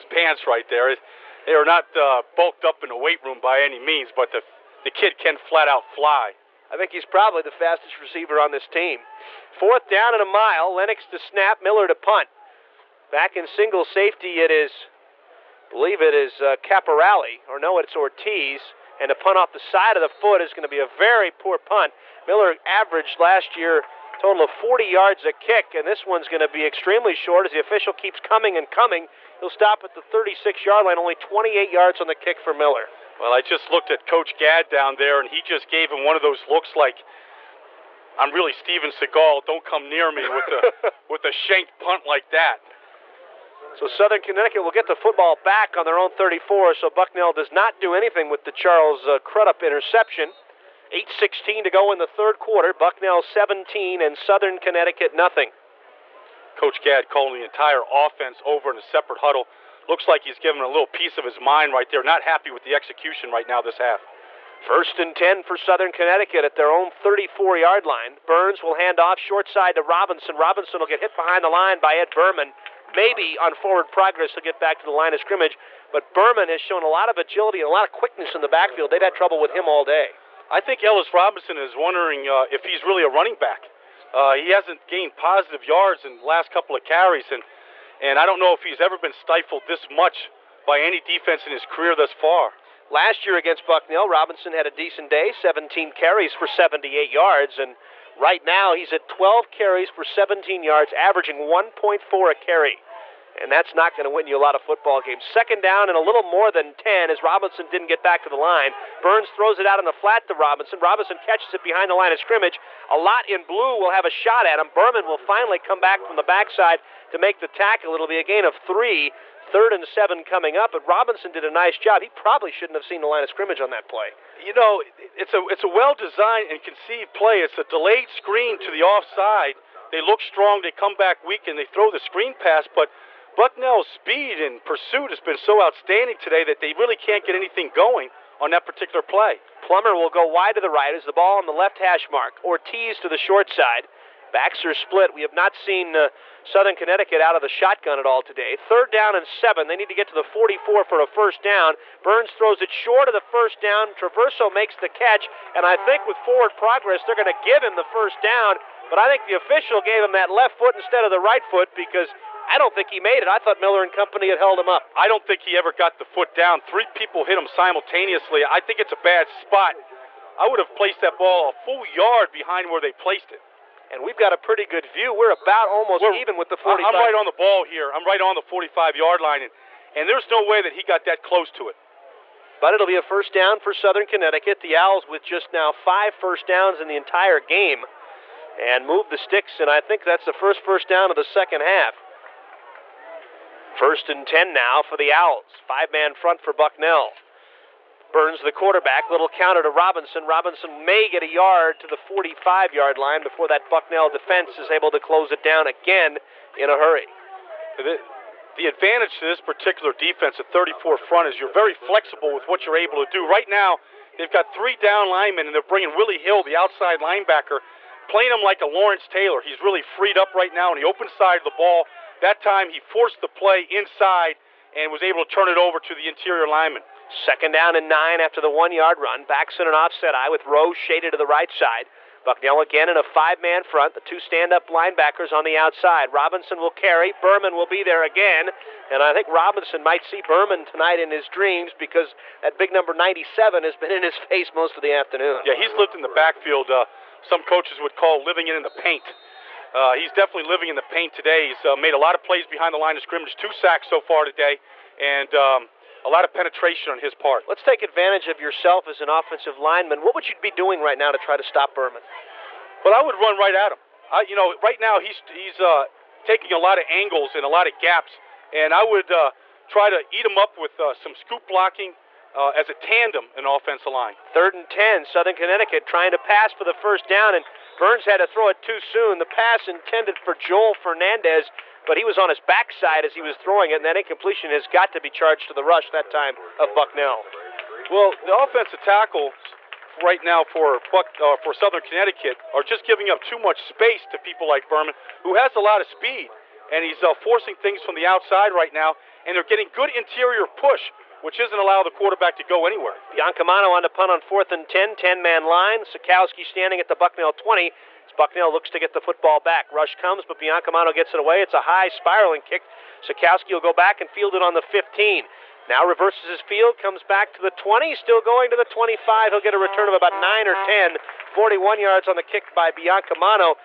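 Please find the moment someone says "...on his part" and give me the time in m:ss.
4:16.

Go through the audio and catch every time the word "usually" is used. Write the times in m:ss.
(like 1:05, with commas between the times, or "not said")
not said.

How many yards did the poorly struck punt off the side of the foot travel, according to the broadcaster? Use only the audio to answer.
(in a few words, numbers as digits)
28.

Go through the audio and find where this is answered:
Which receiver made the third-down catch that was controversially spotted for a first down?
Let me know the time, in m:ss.
2:33.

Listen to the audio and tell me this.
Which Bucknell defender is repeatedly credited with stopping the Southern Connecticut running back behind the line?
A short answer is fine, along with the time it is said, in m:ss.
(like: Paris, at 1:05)
Ed Burman, at 1:11.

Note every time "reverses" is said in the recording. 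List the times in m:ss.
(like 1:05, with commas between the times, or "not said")
5:15.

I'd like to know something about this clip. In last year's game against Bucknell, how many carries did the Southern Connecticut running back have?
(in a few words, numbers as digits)
17.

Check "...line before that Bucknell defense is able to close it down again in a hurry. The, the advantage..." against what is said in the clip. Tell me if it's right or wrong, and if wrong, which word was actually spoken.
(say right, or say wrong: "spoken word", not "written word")
right.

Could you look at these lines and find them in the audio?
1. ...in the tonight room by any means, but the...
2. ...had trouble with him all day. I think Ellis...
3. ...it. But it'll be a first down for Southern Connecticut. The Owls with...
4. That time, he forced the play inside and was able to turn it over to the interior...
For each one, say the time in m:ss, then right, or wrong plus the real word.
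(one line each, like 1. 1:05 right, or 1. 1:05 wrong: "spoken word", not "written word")
1. 0:02 wrong: "weight", not "tonight"
2. 1:19 right
3. 3:01 right
4. 3:42 right.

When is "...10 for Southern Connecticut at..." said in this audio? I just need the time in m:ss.
1:05.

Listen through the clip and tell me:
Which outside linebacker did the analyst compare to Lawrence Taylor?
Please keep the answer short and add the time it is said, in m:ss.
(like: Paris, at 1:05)
Willie Hill, at 3:35.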